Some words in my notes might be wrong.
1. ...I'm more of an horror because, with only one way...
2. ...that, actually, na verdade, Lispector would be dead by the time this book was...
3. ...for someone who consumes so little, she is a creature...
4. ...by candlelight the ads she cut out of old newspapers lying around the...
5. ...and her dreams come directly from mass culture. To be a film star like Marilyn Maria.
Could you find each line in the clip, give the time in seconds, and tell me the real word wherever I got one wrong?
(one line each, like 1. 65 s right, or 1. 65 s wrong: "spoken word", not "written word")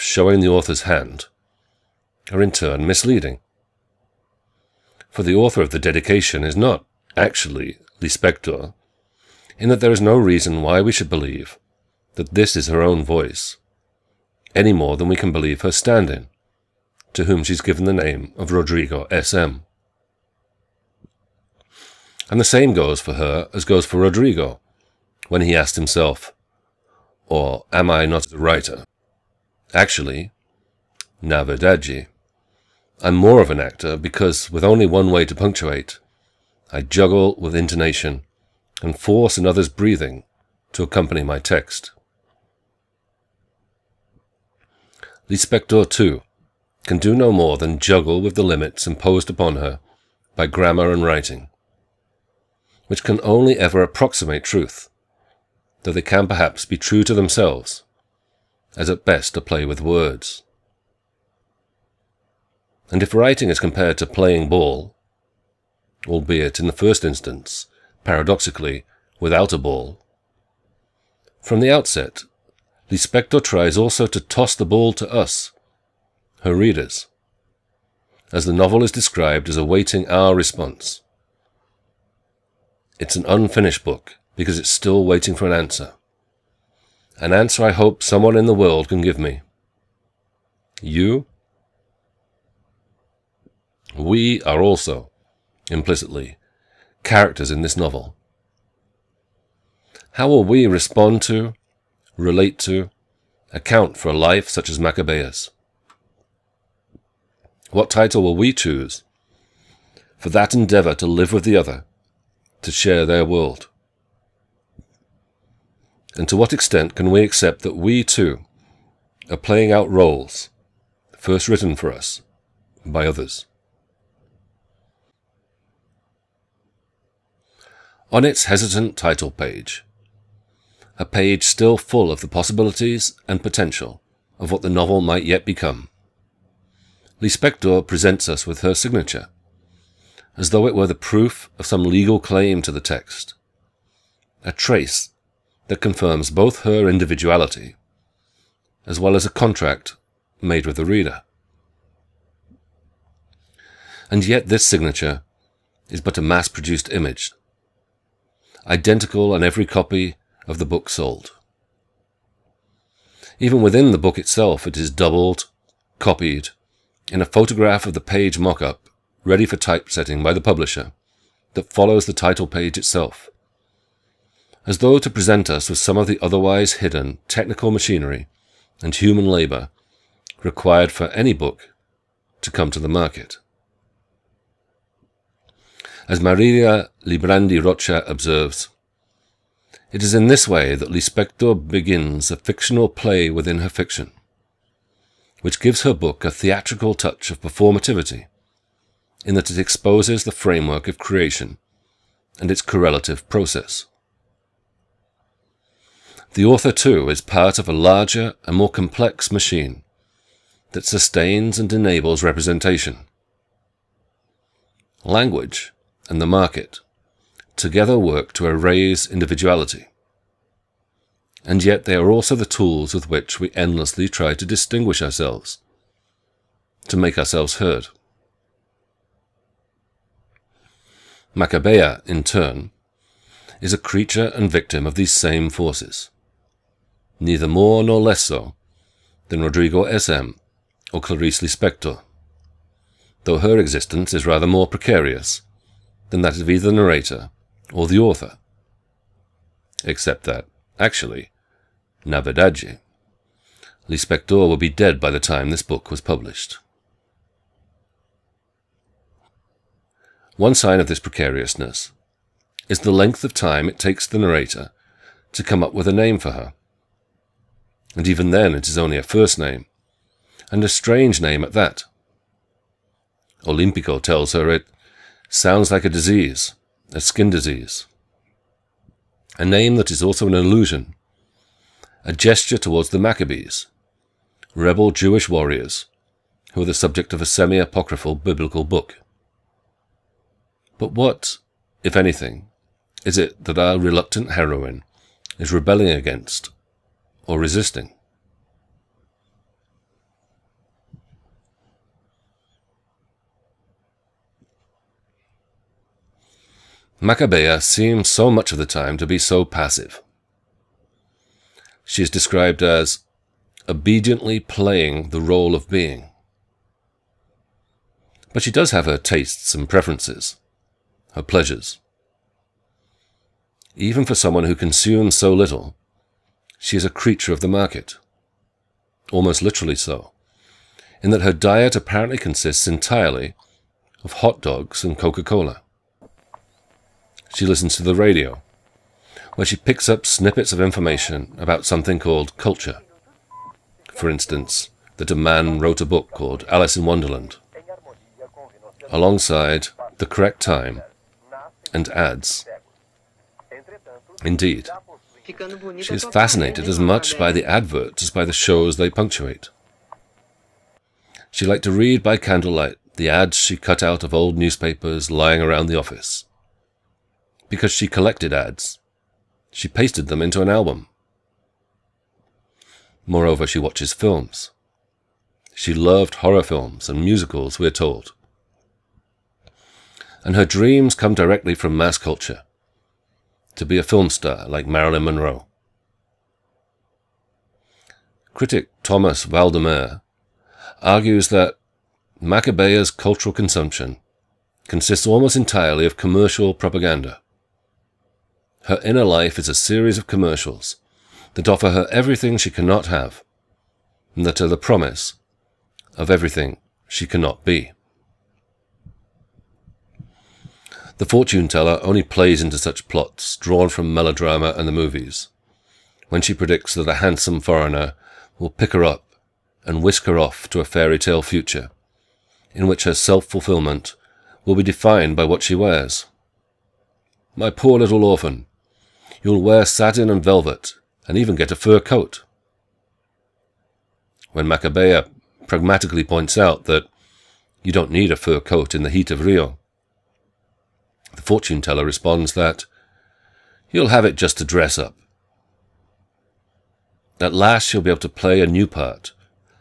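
1. 33 s wrong: "actor", not "horror"
2. 250 s right
3. 324 s right
4. 362 s right
5. 380 s wrong: "Monroe", not "Maria".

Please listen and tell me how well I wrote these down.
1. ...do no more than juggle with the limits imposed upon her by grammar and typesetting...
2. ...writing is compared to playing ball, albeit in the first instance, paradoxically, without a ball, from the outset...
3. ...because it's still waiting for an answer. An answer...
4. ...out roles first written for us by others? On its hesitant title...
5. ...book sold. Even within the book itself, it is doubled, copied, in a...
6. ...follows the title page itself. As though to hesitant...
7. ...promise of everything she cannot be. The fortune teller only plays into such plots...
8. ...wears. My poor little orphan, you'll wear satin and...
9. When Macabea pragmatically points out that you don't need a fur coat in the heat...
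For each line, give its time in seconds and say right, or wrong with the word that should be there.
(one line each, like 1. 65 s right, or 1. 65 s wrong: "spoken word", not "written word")
1. 46 s wrong: "writing", not "typesetting"
2. 63 s right
3. 84 s right
4. 119 s right
5. 160 s right
6. 171 s wrong: "present", not "hesitant"
7. 404 s right
8. 425 s right
9. 434 s right.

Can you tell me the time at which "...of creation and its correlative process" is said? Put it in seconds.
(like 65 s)
200 s.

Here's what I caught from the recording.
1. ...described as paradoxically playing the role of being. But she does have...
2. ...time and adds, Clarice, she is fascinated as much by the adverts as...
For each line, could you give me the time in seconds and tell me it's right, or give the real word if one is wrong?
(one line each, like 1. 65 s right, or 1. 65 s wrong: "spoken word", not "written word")
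1. 312 s wrong: "obediently", not "paradoxically"
2. 350 s wrong: "Indeed", not "Clarice".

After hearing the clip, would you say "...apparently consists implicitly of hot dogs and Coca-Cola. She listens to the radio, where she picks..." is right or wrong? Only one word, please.
wrong.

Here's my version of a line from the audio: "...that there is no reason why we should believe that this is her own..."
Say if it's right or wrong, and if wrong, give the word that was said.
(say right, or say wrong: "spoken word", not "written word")
right.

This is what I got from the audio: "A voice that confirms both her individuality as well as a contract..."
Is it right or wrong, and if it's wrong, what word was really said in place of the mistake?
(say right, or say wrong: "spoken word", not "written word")
wrong: "trace", not "voice".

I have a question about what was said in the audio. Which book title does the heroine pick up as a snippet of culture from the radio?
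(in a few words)
Alice in Wonderland.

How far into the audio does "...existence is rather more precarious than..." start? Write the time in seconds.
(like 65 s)
243 s.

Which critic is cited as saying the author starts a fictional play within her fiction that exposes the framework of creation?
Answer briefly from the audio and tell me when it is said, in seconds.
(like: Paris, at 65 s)
Maria Librandi Rocha, at 186 s.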